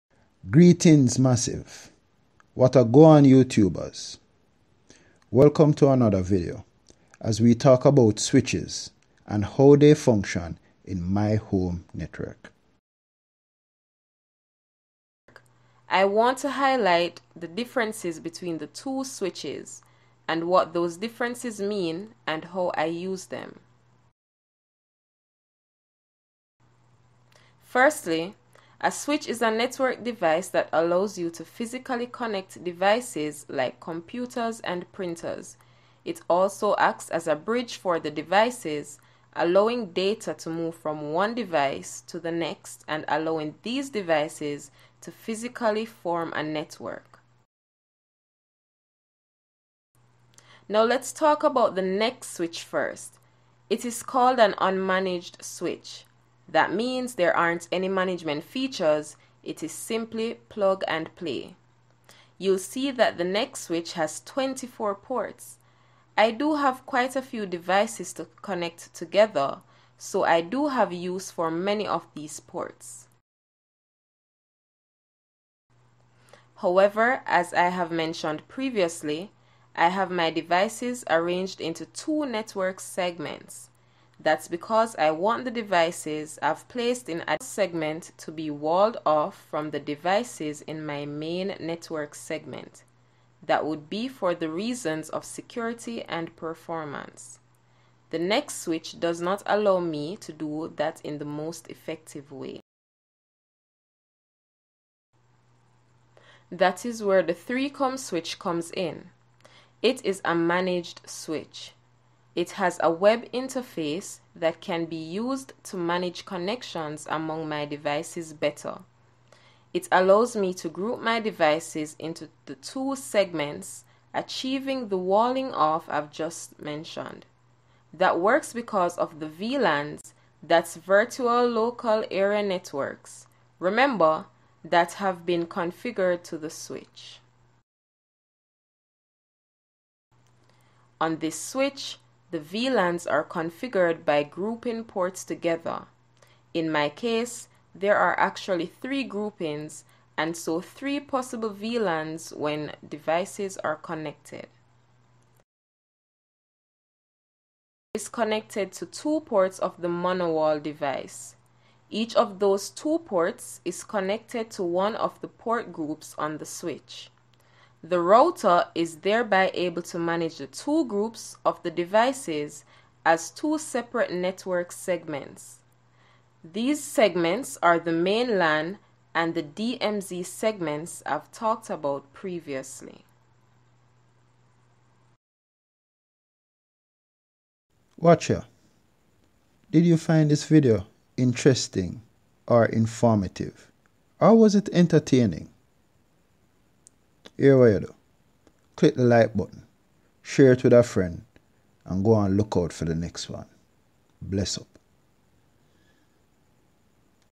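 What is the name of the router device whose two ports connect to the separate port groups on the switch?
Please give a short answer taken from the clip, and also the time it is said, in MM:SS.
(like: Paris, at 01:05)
m0n0wall, at 02:39.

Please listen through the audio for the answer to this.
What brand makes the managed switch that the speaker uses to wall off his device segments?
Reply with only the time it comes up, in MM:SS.
01:47.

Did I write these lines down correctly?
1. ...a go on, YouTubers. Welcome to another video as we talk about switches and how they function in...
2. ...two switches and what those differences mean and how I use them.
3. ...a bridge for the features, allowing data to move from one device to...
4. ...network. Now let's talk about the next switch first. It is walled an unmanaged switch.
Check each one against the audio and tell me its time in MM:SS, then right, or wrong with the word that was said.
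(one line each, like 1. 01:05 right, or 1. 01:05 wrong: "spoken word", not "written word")
1. 00:02 right
2. 00:18 right
3. 00:37 wrong: "devices", not "features"
4. 00:46 wrong: "called", not "walled".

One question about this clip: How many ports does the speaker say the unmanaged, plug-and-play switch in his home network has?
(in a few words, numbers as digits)
24.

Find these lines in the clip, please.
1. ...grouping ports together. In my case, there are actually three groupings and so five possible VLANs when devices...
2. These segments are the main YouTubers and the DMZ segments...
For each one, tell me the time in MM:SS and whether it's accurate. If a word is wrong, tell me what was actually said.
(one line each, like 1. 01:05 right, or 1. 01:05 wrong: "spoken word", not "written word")
1. 02:24 wrong: "three", not "five"
2. 02:56 wrong: "LAN", not "YouTubers".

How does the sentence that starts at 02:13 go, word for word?
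Remember, that have been configured to the switch.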